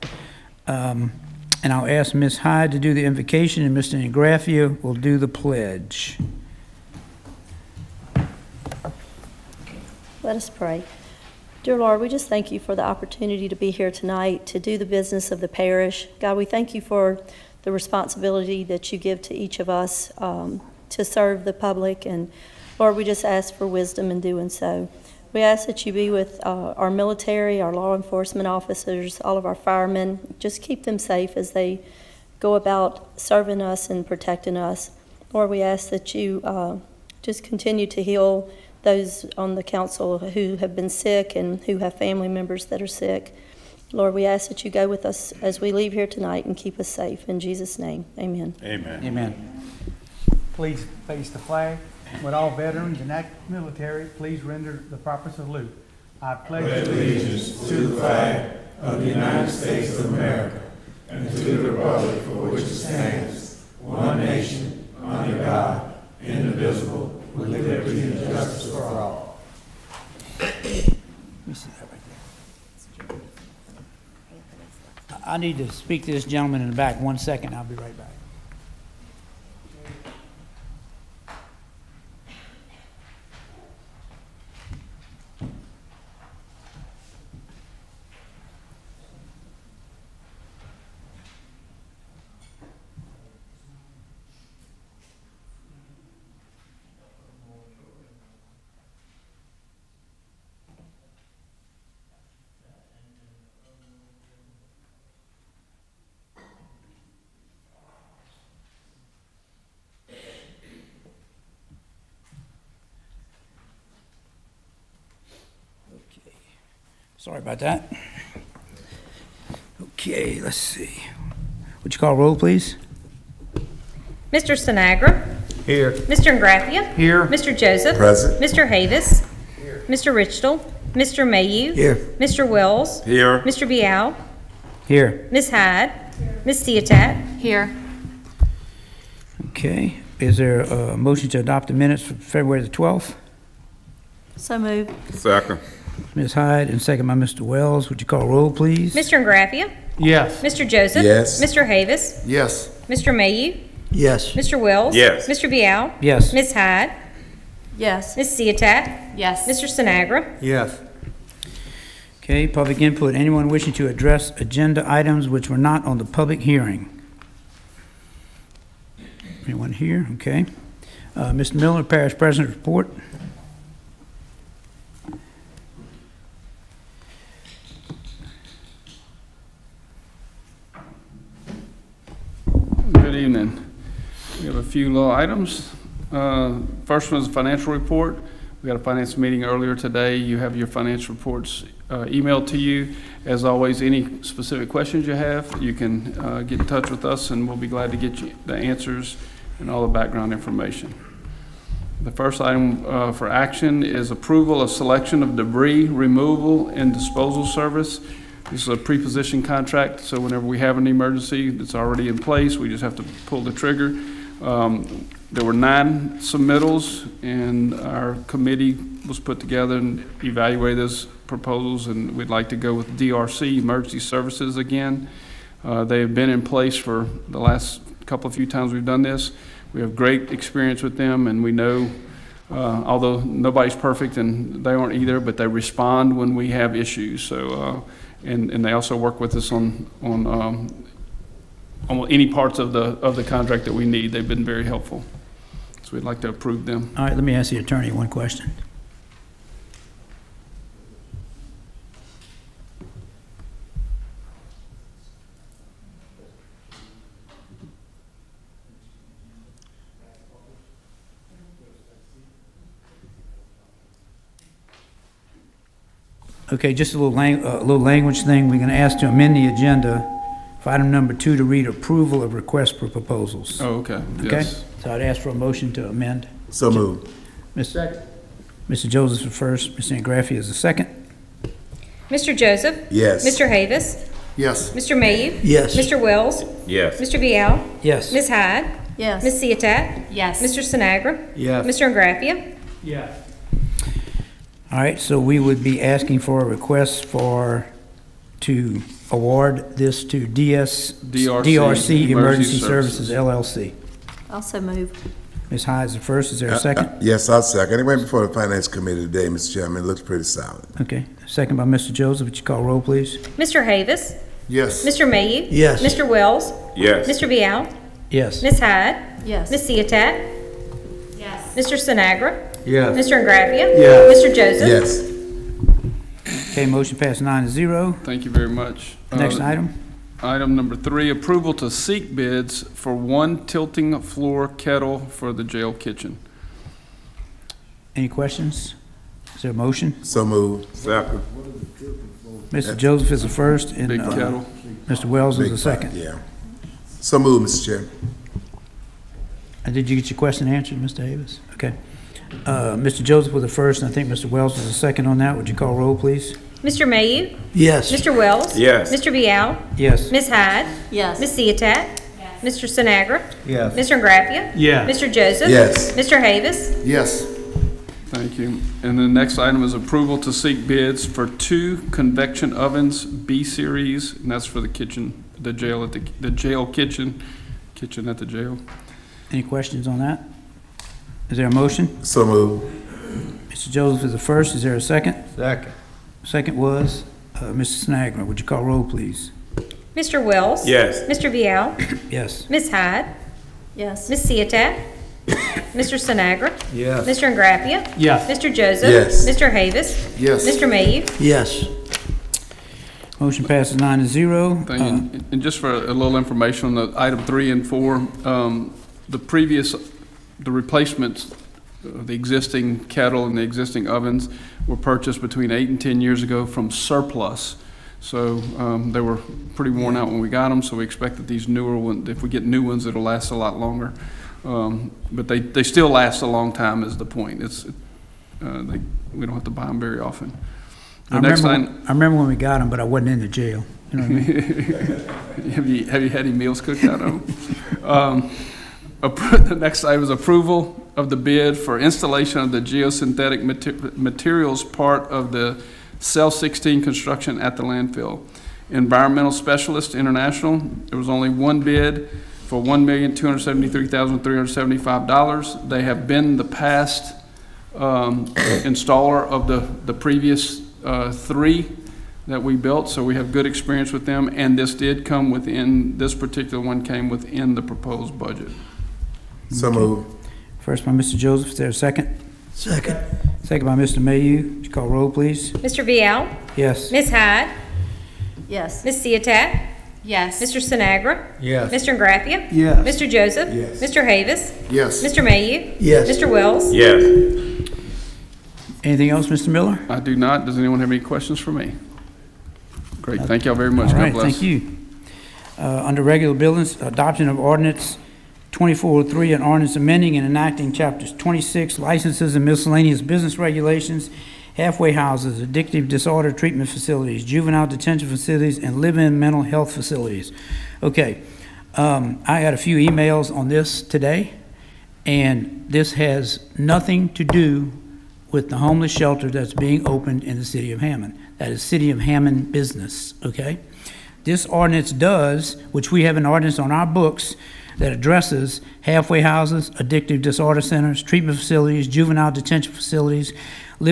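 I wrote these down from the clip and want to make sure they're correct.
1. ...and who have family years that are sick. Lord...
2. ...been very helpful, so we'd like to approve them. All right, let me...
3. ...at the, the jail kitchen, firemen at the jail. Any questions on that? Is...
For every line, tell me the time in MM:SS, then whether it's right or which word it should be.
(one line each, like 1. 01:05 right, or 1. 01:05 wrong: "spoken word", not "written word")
1. 00:41 wrong: "members", not "years"
2. 04:04 right
3. 06:15 wrong: "kitchen", not "firemen".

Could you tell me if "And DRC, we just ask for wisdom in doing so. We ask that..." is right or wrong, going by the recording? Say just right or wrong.
wrong.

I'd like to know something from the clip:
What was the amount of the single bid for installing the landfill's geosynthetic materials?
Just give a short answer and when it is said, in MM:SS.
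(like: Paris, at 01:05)
$1,273,375, at 07:32.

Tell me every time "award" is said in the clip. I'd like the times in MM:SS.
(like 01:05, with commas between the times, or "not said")
04:59.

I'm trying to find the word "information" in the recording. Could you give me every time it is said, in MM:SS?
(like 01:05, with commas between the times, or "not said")
03:20, 06:46.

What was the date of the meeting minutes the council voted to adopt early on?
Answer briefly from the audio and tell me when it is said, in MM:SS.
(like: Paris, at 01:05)
February 12th, at 02:22.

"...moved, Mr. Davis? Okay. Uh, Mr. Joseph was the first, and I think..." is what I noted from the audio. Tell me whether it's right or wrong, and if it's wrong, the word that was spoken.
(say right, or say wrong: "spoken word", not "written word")
wrong: "answered", not "moved".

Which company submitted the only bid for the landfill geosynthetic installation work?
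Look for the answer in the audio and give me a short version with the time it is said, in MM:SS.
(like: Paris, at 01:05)
Environmental Specialist International, at 07:28.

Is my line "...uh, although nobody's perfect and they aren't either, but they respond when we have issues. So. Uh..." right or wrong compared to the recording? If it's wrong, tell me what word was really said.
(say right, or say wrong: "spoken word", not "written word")
right.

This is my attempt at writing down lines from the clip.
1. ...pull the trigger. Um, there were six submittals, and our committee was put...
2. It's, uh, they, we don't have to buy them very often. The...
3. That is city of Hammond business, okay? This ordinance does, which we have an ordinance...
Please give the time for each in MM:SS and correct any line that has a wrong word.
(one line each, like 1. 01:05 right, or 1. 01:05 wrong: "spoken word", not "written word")
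1. 03:33 wrong: "nine", not "six"
2. 07:07 right
3. 08:41 right.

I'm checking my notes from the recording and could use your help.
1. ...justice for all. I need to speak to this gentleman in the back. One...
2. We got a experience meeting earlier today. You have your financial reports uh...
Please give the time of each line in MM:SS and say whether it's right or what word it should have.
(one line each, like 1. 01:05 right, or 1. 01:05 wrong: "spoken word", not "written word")
1. 01:08 right
2. 03:08 wrong: "finance", not "experience".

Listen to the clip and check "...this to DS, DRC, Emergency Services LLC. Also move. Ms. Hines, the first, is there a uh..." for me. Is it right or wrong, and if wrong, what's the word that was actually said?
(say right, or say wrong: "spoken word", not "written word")
right.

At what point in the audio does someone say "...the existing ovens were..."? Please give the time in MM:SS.
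06:53.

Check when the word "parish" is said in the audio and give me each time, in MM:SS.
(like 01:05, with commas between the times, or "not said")
00:15, 02:51.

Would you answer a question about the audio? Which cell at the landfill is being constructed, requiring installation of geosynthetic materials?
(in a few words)
Cell 16.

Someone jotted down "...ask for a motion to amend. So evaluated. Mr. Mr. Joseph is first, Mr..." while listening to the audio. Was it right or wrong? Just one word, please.
wrong.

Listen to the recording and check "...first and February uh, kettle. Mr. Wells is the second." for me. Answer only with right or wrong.
wrong.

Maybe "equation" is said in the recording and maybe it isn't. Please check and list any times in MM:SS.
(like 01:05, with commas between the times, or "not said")
not said.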